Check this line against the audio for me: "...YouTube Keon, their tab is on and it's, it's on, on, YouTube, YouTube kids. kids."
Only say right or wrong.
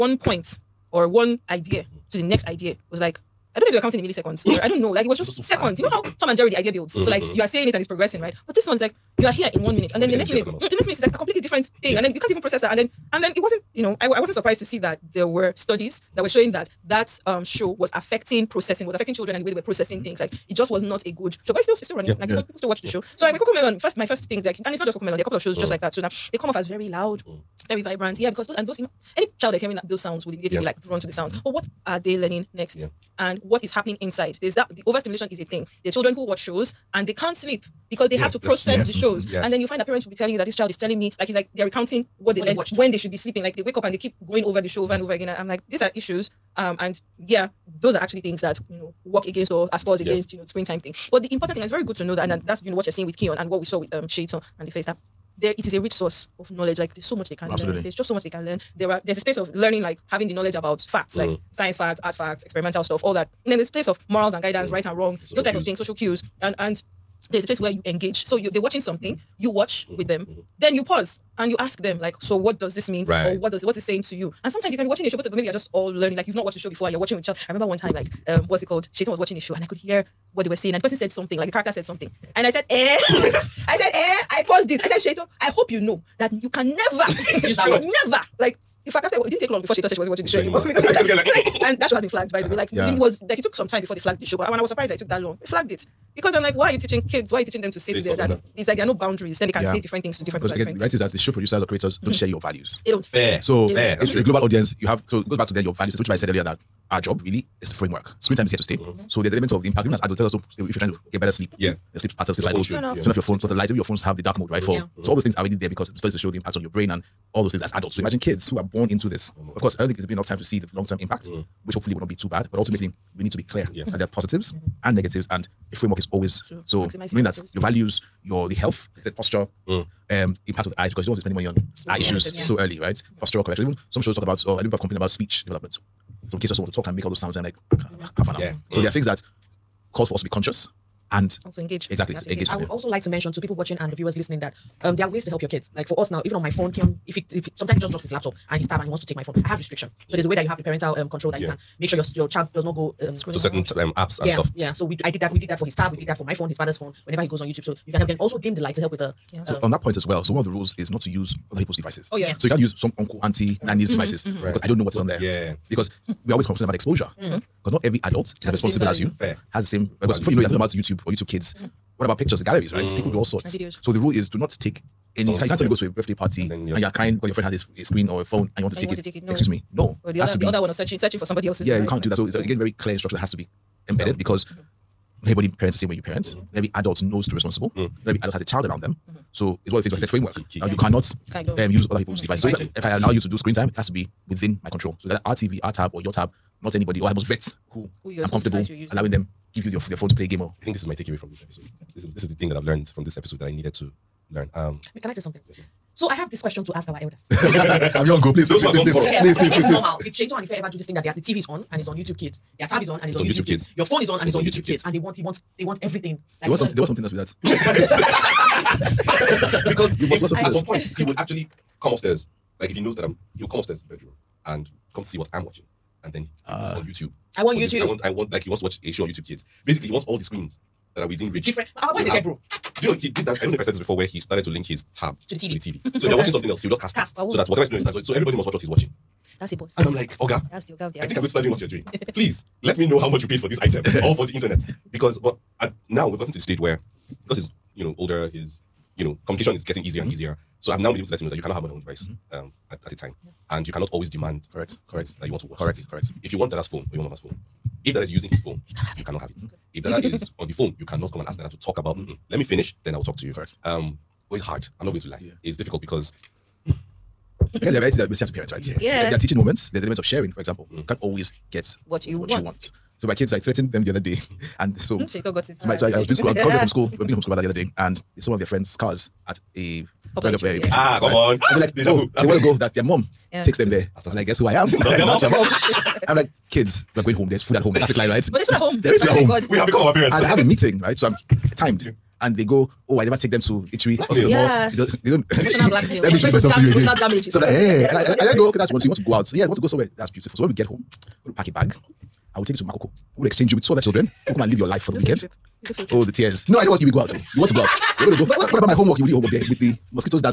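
wrong.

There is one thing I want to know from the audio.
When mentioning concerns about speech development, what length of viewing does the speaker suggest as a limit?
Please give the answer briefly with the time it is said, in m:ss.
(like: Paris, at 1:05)
half an hour, at 2:18.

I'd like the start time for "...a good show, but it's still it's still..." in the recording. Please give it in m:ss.
0:21.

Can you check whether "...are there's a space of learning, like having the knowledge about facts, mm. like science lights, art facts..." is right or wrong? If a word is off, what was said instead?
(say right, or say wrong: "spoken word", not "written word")
wrong: "facts", not "lights".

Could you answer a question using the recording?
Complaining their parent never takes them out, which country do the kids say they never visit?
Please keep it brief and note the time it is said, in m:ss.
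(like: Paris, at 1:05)
Italy, at 4:53.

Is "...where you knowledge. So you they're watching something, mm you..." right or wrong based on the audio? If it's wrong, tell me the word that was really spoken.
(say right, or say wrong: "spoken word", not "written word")
wrong: "engage", not "knowledge".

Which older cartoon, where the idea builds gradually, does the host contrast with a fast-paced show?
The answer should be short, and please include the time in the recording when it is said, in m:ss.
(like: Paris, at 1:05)
Tom and Jerry, at 0:06.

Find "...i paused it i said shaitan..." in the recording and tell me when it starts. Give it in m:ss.
1:24.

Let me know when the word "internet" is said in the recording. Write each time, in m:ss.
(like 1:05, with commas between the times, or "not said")
4:04.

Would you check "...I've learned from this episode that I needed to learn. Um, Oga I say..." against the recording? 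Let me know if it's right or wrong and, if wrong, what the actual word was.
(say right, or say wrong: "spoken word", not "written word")
wrong: "Can", not "Oga".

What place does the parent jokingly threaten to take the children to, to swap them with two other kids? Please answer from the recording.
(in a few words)
Makoko.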